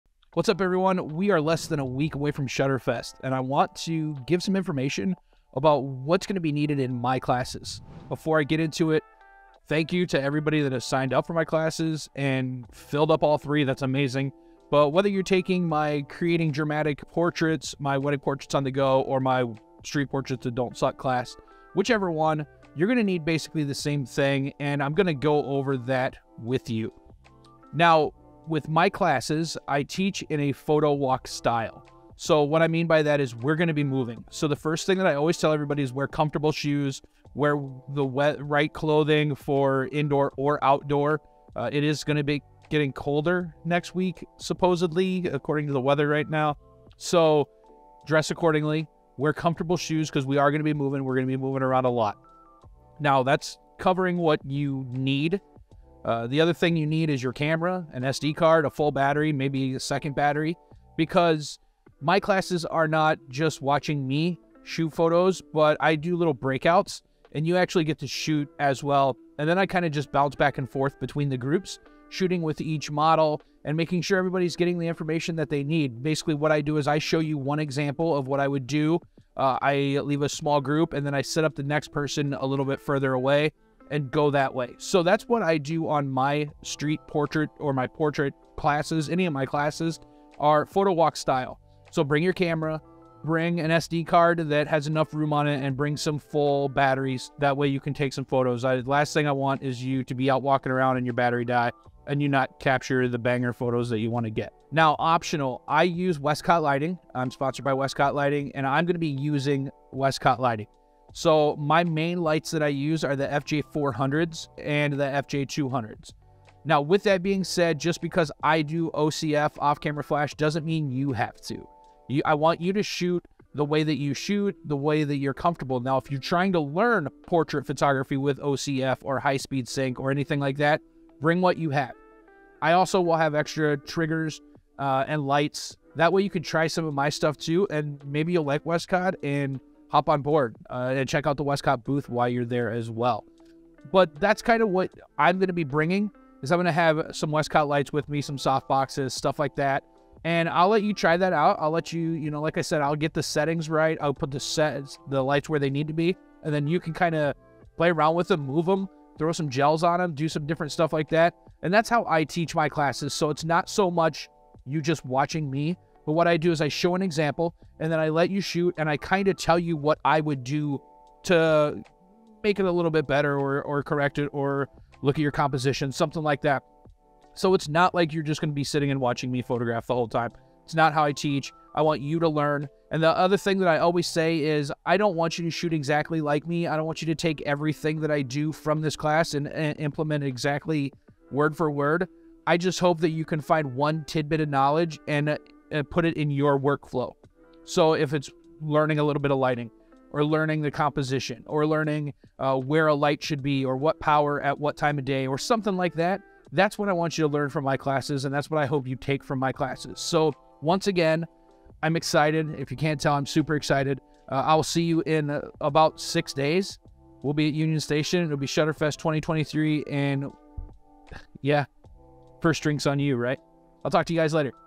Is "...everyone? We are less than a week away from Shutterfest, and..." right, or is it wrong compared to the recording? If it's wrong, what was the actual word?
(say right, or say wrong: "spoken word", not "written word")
right.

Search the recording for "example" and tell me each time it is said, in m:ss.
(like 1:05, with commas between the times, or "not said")
1:17, 2:47.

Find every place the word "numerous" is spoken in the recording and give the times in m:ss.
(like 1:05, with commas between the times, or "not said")
not said.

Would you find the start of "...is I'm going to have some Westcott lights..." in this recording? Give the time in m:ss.
2:26.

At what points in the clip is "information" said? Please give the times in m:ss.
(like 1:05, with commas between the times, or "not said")
0:04, 1:14.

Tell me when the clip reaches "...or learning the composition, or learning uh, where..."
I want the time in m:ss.
3:20.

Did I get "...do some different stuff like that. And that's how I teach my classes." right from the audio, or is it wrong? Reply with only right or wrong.
right.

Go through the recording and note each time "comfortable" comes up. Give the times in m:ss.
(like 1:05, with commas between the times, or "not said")
0:36, 0:49, 2:05.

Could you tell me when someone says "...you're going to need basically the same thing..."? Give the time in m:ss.
0:22.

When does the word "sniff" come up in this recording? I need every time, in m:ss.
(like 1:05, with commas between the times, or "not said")
not said.